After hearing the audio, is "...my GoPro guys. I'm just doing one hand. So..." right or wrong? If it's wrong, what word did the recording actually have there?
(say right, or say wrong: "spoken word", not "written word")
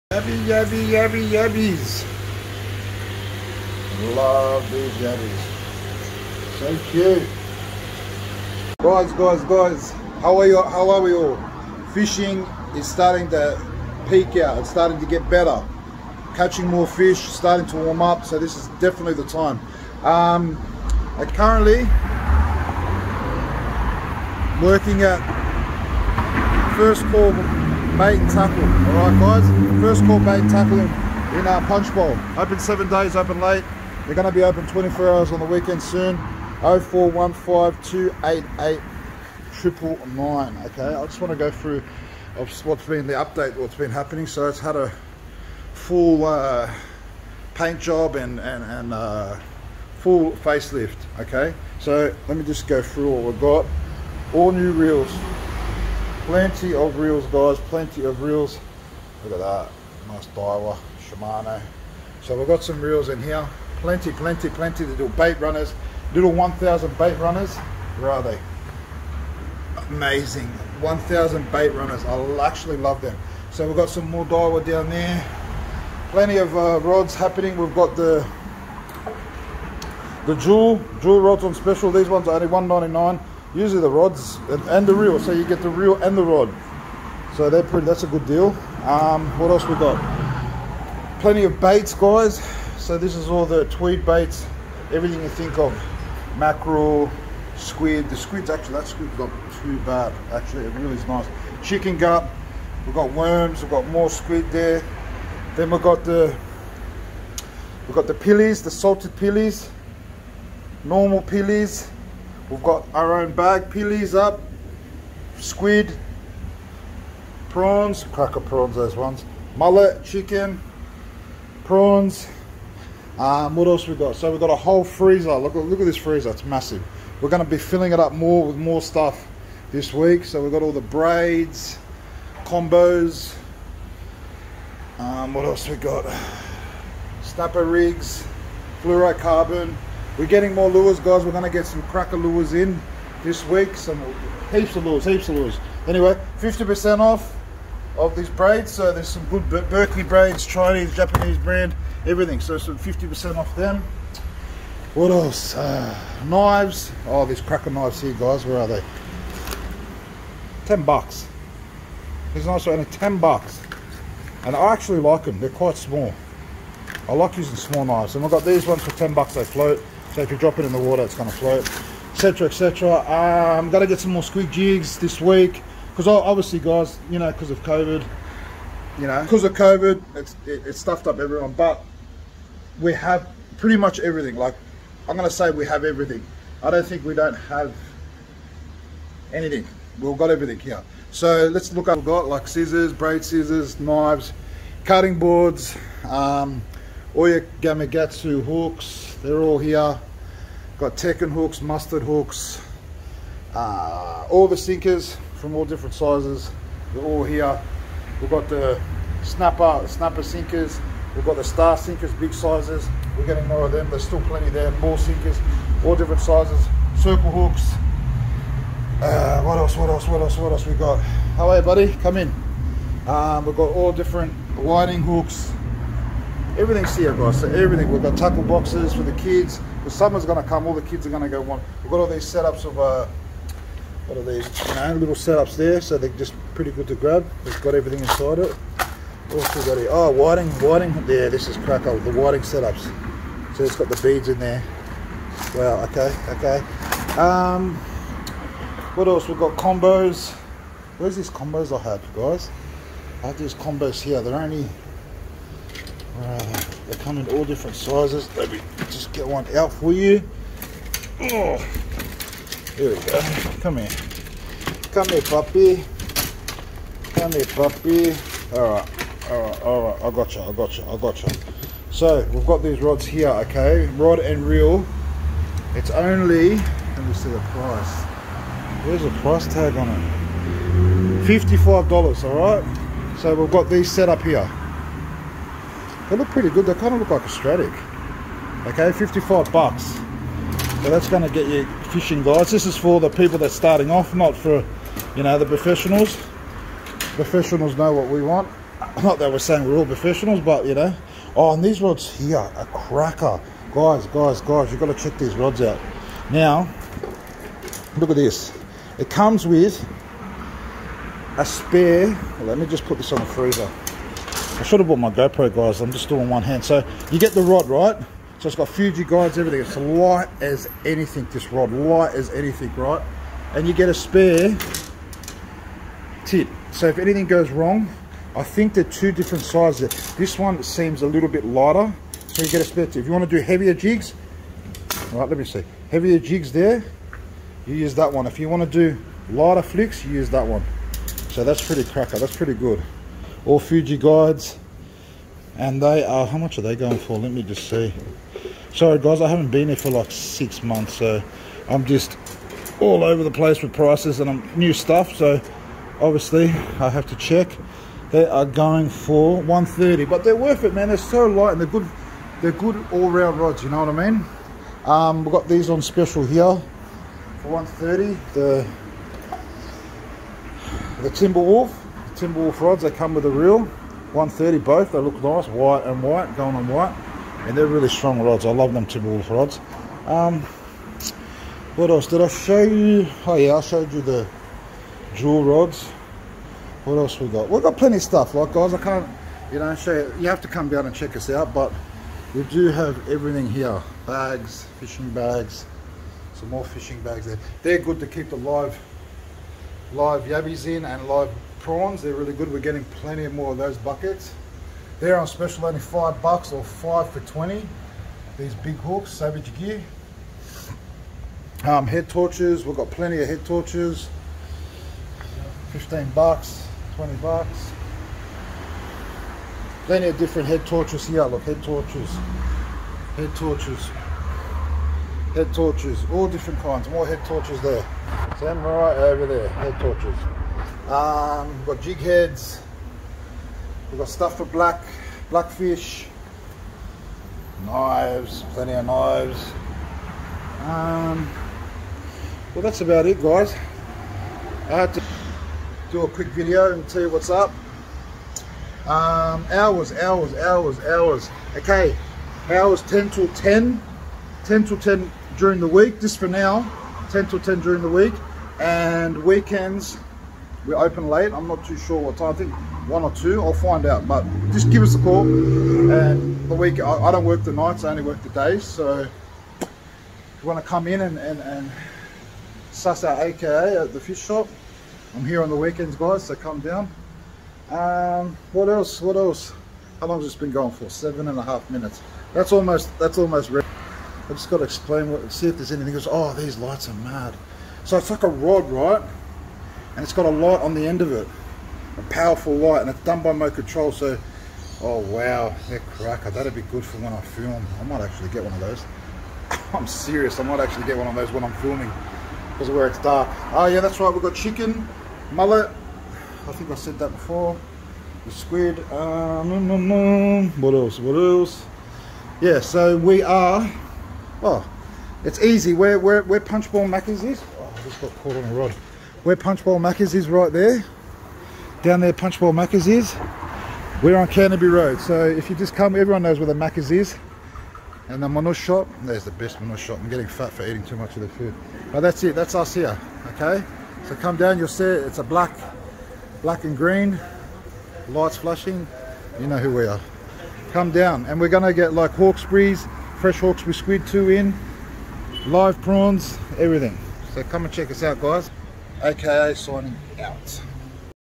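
right.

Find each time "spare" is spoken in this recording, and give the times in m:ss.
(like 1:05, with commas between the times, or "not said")
5:11, 5:23, 5:32.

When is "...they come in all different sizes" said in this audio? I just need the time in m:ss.
4:16.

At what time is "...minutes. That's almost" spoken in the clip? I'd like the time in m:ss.
8:01.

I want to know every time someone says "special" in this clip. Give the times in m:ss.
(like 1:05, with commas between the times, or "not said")
1:21, 6:05, 6:45.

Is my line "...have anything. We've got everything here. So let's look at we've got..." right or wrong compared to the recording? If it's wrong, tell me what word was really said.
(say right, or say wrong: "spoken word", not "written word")
right.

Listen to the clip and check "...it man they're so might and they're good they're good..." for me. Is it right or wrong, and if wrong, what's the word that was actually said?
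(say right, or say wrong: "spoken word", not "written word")
wrong: "light", not "might".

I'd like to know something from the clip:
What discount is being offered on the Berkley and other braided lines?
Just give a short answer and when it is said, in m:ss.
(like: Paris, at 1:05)
50%, at 2:26.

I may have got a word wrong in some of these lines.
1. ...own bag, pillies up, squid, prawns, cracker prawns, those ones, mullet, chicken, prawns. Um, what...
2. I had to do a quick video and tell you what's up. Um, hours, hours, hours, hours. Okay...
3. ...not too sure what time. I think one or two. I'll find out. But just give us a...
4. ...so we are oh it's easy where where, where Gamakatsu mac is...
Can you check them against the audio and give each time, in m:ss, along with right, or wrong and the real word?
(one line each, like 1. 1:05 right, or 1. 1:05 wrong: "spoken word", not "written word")
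1. 1:53 right
2. 7:24 right
3. 7:41 right
4. 8:32 wrong: "Punchbowl", not "Gamakatsu".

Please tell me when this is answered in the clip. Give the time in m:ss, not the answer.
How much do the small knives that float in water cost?
2:42.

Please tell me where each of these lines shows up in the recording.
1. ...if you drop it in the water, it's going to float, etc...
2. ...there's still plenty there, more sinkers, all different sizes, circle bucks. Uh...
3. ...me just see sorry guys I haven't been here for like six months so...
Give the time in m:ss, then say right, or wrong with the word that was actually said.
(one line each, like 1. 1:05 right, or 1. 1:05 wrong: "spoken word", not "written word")
1. 2:50 right
2. 3:33 wrong: "hooks", not "bucks"
3. 5:47 right.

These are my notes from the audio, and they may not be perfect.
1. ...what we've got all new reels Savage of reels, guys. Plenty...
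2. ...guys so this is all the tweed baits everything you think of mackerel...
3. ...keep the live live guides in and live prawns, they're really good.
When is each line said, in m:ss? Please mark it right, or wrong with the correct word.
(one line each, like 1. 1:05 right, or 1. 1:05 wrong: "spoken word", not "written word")
1. 0:53 wrong: "Plenty", not "Savage"
2. 1:31 right
3. 6:38 wrong: "yabbies", not "guides".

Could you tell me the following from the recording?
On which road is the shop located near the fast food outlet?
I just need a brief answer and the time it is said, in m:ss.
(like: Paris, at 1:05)
Canterbury Road, at 8:44.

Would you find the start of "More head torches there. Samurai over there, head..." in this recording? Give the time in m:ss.
7:06.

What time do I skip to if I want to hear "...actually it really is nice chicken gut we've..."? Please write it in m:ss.
1:40.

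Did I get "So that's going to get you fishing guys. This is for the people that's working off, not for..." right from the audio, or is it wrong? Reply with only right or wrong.
wrong.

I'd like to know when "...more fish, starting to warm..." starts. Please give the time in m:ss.
0:16.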